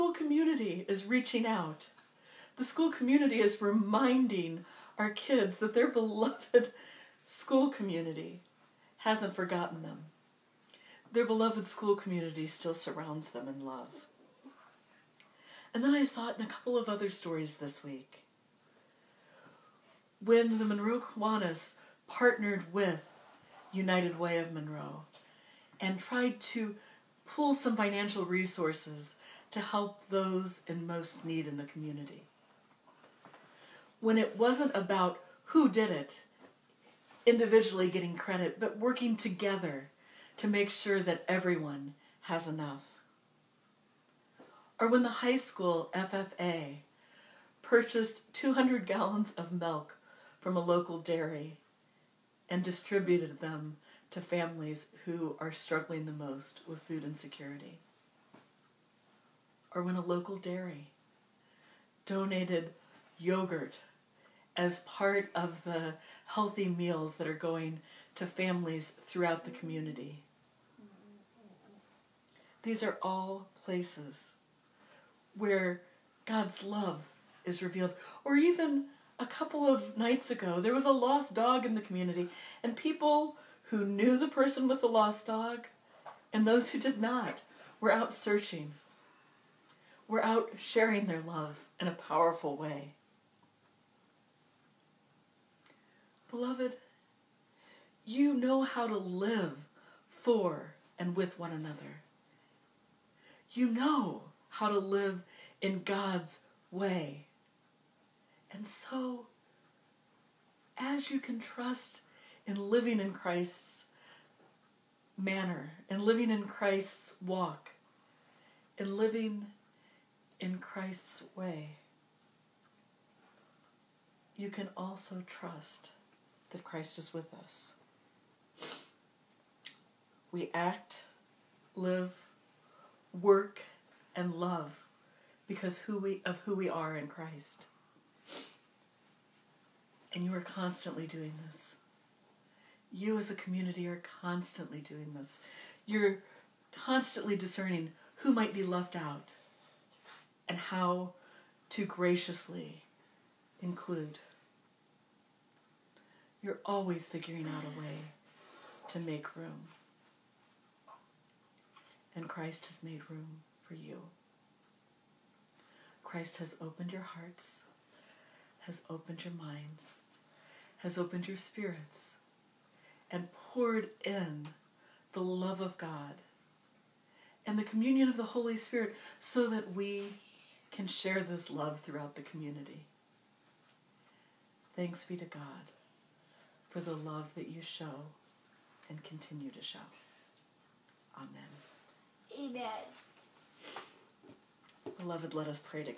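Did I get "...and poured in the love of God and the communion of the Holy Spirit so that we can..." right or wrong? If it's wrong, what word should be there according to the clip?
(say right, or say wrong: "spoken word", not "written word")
right.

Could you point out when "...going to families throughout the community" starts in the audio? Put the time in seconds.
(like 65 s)
67 s.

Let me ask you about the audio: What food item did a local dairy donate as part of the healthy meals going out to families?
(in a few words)
Yogurt.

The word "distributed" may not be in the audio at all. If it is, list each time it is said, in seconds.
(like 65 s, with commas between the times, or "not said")
52 s.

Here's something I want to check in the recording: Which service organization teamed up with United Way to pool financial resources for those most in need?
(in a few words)
Monroe Kiwanis.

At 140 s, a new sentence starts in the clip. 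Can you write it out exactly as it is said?
And you are constantly doing this.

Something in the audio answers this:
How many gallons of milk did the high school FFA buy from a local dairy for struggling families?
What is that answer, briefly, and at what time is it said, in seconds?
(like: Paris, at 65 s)
200, at 48 s.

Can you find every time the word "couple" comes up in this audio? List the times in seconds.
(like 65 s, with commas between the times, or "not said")
16 s, 79 s.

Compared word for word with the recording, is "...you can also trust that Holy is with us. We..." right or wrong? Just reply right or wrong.
wrong.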